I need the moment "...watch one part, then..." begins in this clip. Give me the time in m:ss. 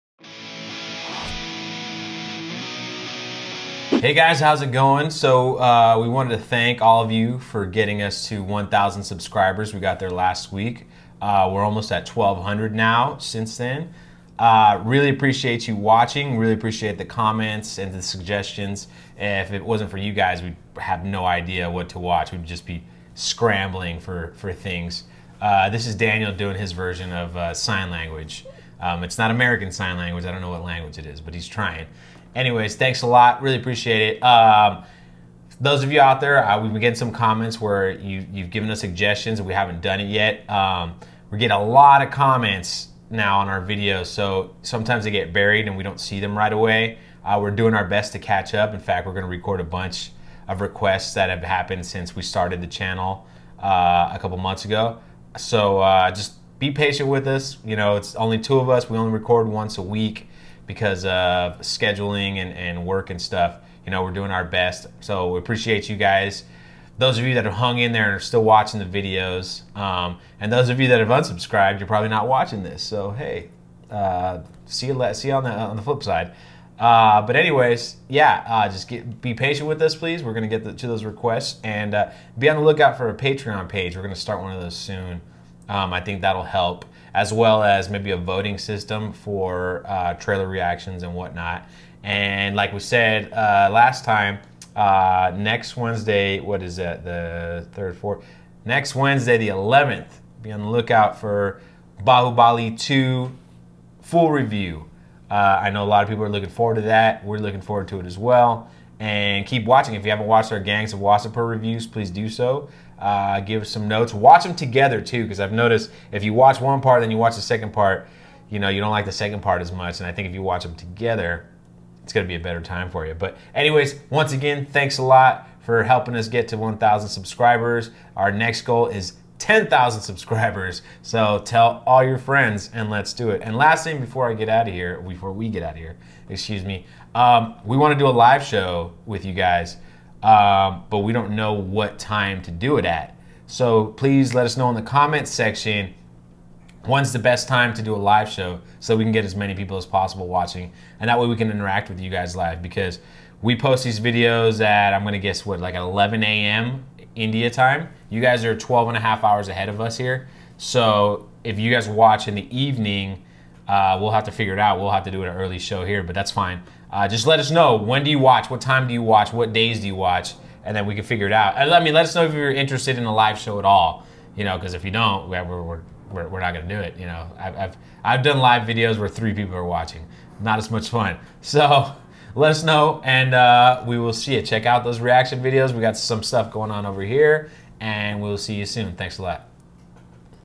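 1:56.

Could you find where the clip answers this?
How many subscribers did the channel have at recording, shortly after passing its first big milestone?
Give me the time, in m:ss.
0:12.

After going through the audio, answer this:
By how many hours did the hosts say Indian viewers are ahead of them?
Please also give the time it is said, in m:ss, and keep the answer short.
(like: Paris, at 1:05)
12 and a half, at 2:38.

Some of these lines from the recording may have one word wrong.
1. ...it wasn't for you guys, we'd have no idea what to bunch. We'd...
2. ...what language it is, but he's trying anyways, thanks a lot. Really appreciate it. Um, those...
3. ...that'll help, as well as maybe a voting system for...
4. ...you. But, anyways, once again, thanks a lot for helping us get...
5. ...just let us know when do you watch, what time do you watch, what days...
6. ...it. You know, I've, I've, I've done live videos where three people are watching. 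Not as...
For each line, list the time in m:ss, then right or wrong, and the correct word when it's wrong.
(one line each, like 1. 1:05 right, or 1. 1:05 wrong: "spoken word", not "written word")
1. 0:19 wrong: "watch", not "bunch"
2. 0:30 right
3. 1:26 right
4. 2:03 right
5. 2:47 right
6. 2:56 right.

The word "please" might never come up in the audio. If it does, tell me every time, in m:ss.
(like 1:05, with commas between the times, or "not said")
1:19, 1:51, 2:23.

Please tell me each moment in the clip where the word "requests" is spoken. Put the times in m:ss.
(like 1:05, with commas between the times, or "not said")
0:50, 1:21.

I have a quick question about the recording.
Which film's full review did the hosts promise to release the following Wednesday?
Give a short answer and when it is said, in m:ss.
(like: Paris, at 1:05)
Bahubali 2, at 1:42.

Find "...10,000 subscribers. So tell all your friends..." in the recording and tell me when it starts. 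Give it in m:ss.
2:09.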